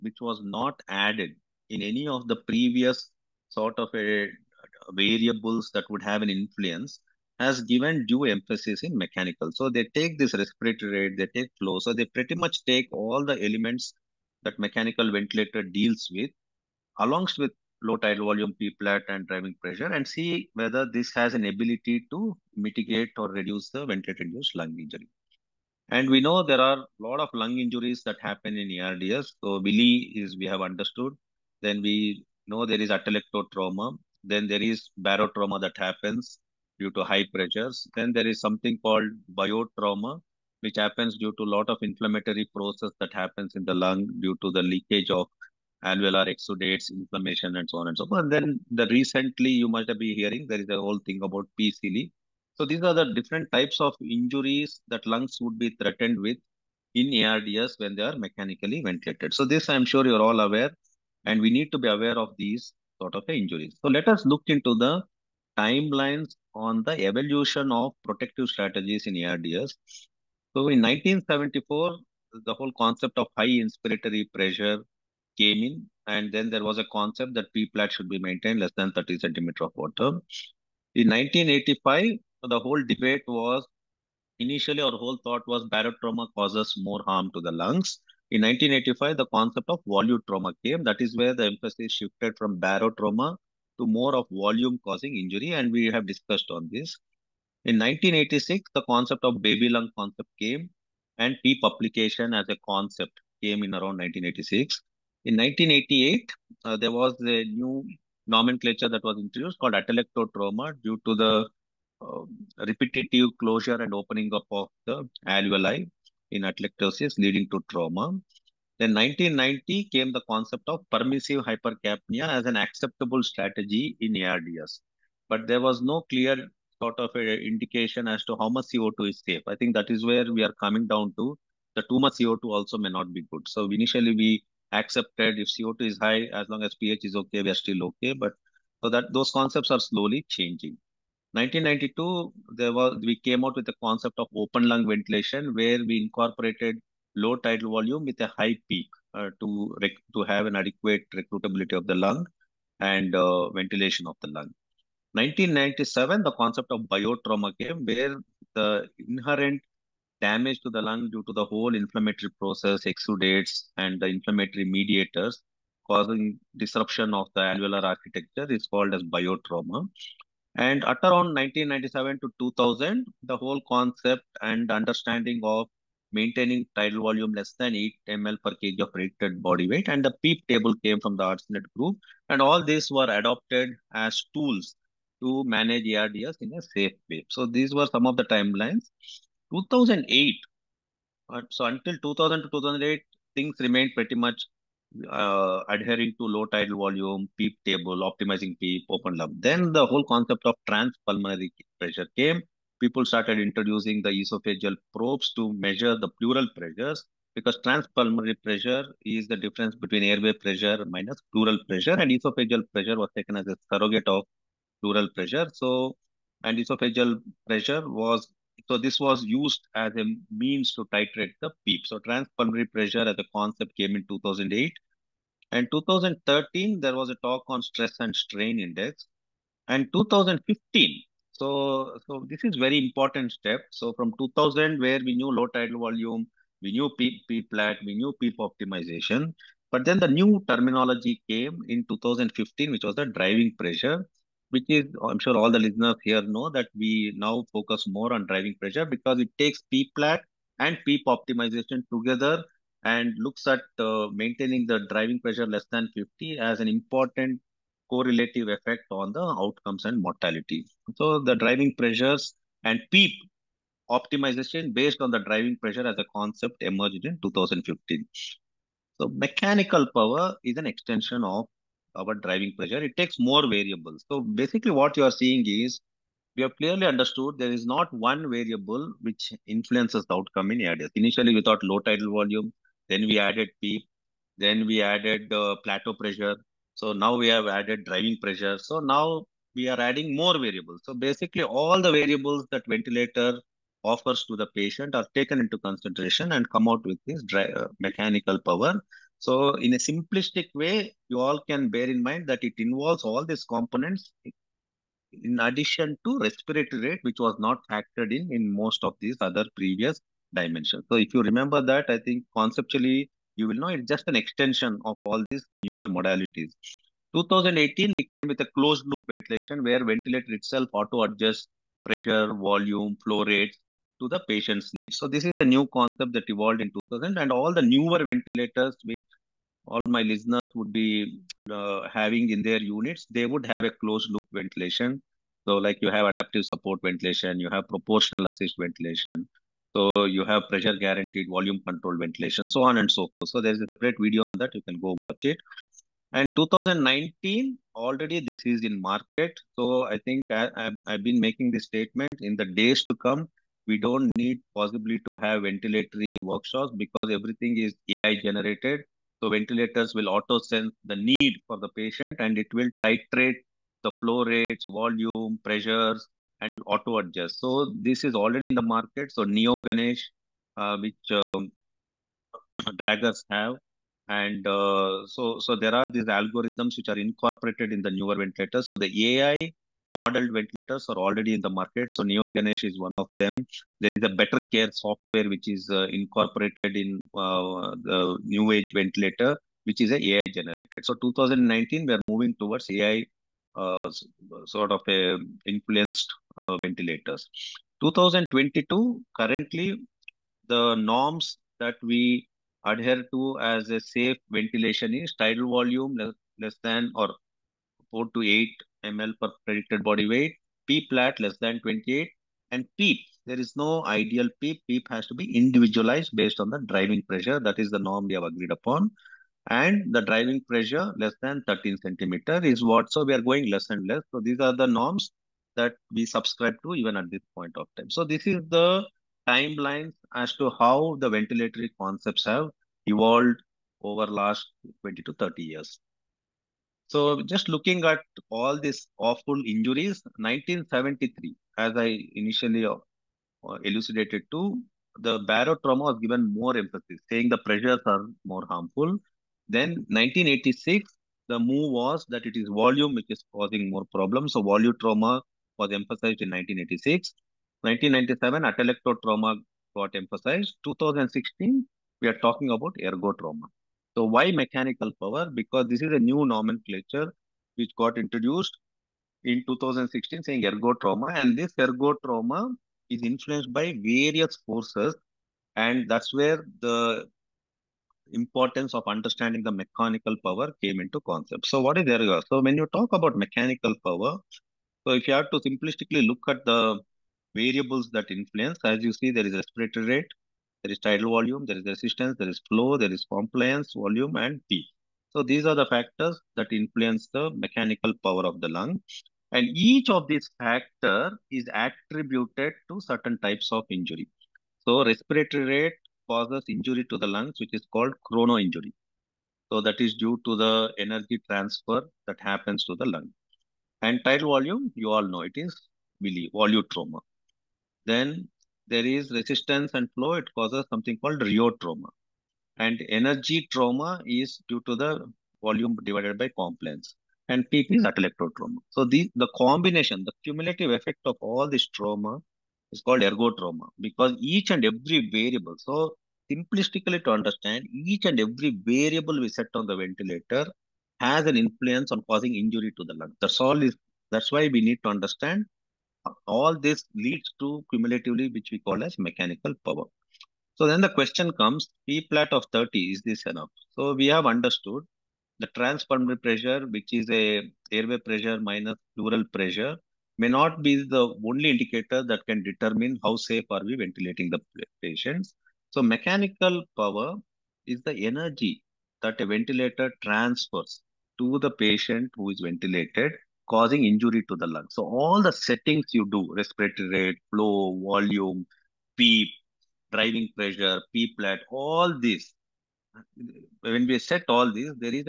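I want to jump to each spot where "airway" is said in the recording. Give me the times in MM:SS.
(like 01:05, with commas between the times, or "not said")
03:30, 09:17.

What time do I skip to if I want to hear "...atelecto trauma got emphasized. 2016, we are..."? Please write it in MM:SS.
07:38.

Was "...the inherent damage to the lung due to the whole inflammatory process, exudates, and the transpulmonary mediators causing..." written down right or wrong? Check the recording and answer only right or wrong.
wrong.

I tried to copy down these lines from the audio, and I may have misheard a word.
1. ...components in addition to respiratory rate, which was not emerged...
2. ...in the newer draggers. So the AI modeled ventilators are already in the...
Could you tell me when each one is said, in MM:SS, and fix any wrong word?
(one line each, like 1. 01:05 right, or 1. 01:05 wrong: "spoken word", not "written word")
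1. 05:03 wrong: "factored", not "emerged"
2. 06:17 wrong: "ventilators", not "draggers".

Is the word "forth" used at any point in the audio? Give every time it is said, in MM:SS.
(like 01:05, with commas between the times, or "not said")
00:48, 05:43.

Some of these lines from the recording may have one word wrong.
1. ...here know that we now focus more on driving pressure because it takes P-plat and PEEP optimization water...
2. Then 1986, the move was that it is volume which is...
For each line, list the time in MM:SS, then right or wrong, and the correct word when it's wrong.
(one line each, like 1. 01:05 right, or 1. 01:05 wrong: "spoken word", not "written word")
1. 04:06 wrong: "together", not "water"
2. 07:29 right.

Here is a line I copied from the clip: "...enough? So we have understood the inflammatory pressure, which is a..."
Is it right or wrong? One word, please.
wrong.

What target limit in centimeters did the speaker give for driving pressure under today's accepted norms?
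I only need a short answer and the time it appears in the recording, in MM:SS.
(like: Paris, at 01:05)
13 centimeter, at 07:00.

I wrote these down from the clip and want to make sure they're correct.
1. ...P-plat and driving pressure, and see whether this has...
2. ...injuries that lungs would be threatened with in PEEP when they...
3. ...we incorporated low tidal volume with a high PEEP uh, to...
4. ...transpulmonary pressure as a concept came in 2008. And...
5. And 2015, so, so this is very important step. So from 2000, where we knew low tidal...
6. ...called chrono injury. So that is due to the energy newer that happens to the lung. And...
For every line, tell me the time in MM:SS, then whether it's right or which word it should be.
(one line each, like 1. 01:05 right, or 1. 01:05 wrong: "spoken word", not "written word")
1. 00:18 right
2. 00:53 wrong: "ARDS", not "PEEP"
3. 02:25 right
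4. 03:41 right
5. 03:49 right
6. 08:27 wrong: "transfer", not "newer".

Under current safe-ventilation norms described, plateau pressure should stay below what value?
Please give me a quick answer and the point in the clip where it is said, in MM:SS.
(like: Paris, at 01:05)
28, at 06:50.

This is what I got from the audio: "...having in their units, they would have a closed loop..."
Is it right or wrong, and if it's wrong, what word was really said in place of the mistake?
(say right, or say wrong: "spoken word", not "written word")
right.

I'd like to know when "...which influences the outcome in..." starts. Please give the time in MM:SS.
04:39.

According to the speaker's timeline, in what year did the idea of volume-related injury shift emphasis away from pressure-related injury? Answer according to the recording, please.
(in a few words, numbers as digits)
1985.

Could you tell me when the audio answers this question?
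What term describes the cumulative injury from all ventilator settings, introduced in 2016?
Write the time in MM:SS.
08:53.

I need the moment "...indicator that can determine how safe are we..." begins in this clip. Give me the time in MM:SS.
09:21.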